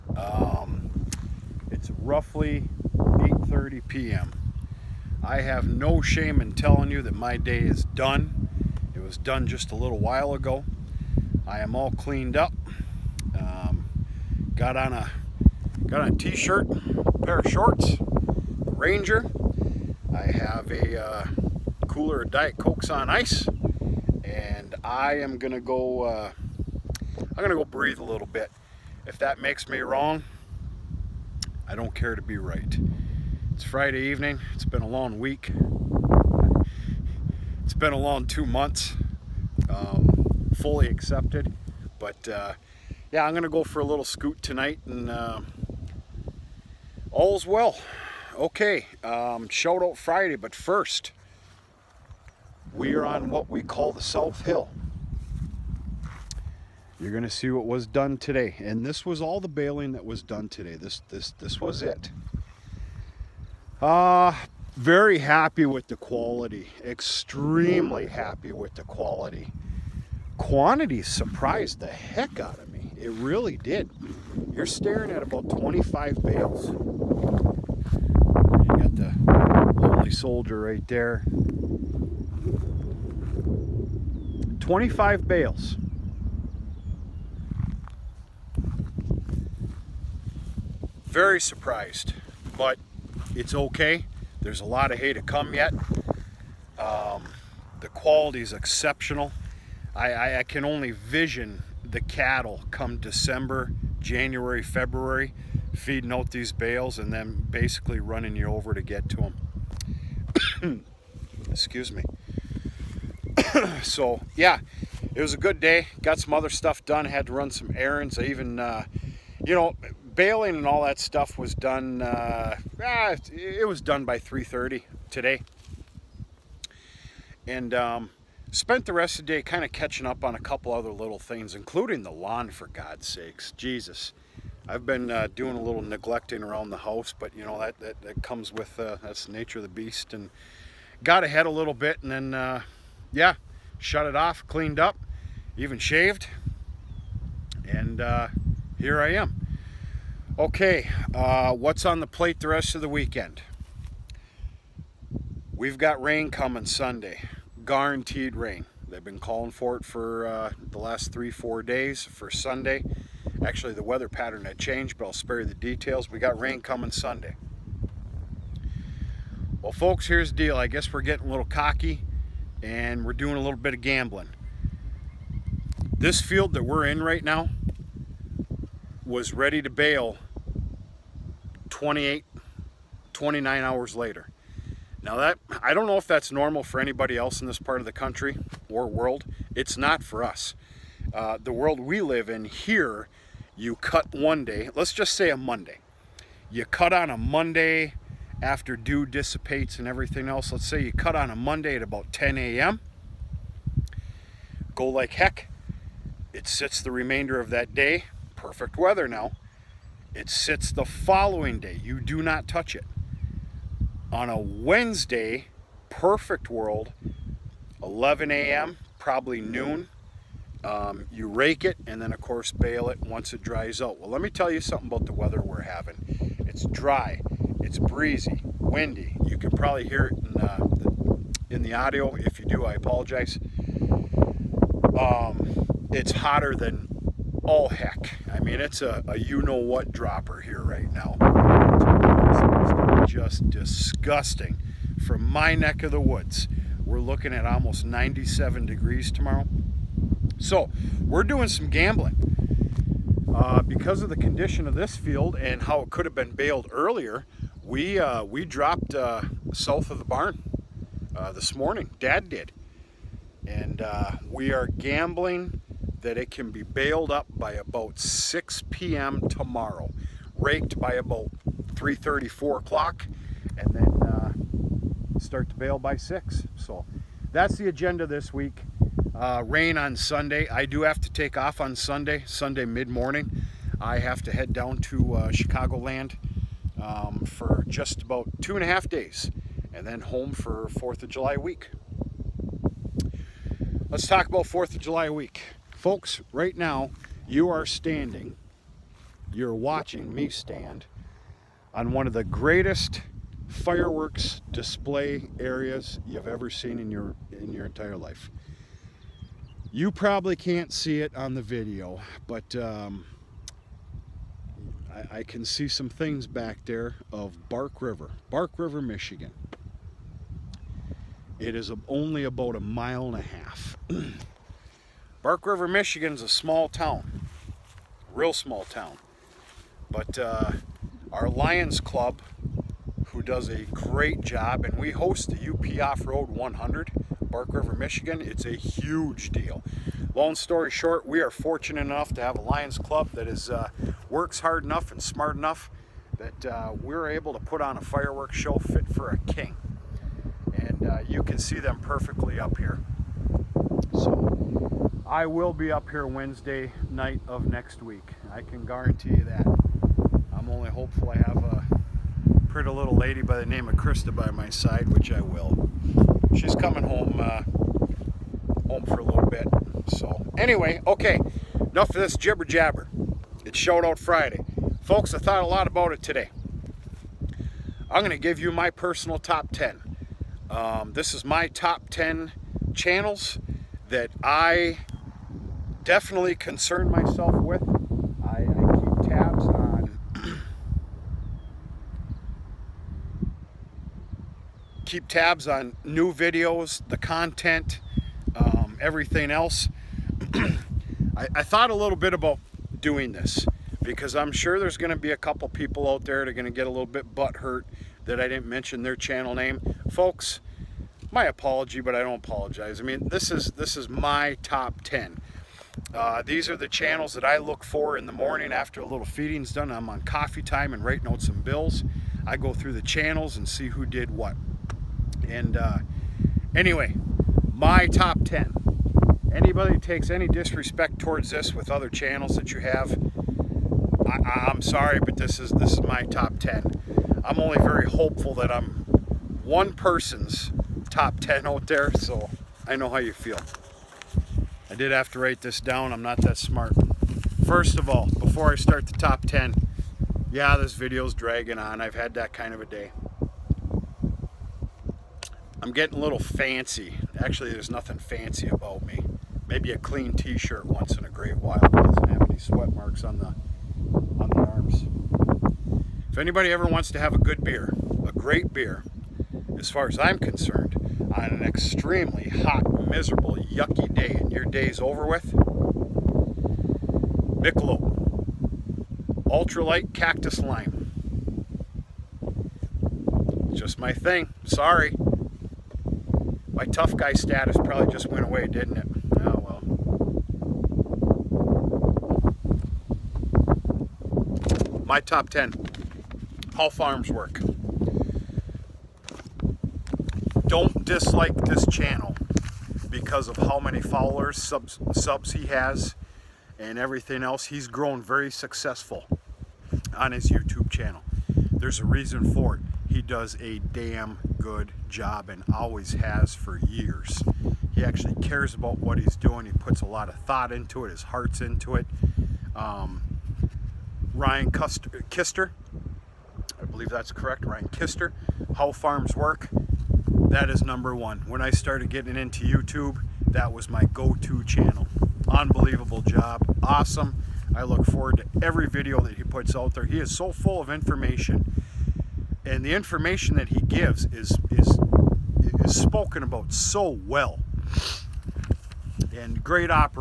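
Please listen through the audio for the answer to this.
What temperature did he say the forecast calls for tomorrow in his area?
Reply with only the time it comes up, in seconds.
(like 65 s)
247 s.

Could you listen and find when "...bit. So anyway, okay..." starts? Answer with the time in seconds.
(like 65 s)
369 s.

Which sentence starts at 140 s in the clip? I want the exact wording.
And got ahead a little bit, and then uh, yeah, shut it off, cleaned up, even shaved.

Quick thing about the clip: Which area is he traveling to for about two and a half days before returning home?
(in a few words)
Chicagoland.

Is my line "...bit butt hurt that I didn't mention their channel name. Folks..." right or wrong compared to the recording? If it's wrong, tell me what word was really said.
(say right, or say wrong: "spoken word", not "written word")
right.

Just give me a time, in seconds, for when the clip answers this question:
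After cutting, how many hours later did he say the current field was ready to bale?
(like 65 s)
183 s.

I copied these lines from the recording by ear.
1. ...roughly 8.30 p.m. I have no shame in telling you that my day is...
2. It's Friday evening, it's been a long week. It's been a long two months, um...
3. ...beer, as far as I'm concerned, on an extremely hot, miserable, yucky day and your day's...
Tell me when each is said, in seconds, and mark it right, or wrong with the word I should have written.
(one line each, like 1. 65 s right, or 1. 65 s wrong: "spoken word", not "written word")
1. 1 s right
2. 33 s right
3. 468 s right.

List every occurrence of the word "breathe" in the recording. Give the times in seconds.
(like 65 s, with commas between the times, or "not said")
27 s.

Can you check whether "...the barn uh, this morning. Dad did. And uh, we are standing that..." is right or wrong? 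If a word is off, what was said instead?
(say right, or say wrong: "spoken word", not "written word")
wrong: "gambling", not "standing".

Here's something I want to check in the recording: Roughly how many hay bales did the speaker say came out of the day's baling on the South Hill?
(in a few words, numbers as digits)
25.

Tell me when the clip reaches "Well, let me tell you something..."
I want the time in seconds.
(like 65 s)
223 s.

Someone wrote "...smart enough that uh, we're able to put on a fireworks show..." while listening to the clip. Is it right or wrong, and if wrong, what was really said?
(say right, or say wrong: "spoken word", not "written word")
right.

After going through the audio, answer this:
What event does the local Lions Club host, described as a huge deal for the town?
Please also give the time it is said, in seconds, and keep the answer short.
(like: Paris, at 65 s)
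UP Off-Road 100, at 335 s.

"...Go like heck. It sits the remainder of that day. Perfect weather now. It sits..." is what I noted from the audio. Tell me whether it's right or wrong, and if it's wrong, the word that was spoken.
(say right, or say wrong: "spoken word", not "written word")
right.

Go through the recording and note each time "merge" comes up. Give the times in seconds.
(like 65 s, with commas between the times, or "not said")
not said.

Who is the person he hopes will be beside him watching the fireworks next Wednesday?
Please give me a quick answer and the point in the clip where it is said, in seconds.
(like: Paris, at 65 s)
Krista, at 363 s.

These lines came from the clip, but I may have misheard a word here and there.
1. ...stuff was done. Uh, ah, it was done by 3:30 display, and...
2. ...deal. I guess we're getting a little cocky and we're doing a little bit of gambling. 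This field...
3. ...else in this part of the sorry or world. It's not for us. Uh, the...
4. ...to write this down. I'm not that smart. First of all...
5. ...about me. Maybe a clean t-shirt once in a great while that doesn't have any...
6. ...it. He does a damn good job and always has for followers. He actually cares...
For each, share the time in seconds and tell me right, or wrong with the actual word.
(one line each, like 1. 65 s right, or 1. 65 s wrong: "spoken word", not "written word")
1. 120 s wrong: "today", not "display"
2. 170 s right
3. 187 s wrong: "country", not "sorry"
4. 445 s right
5. 458 s right
6. 512 s wrong: "years", not "followers".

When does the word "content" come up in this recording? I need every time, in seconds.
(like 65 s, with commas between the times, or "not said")
396 s.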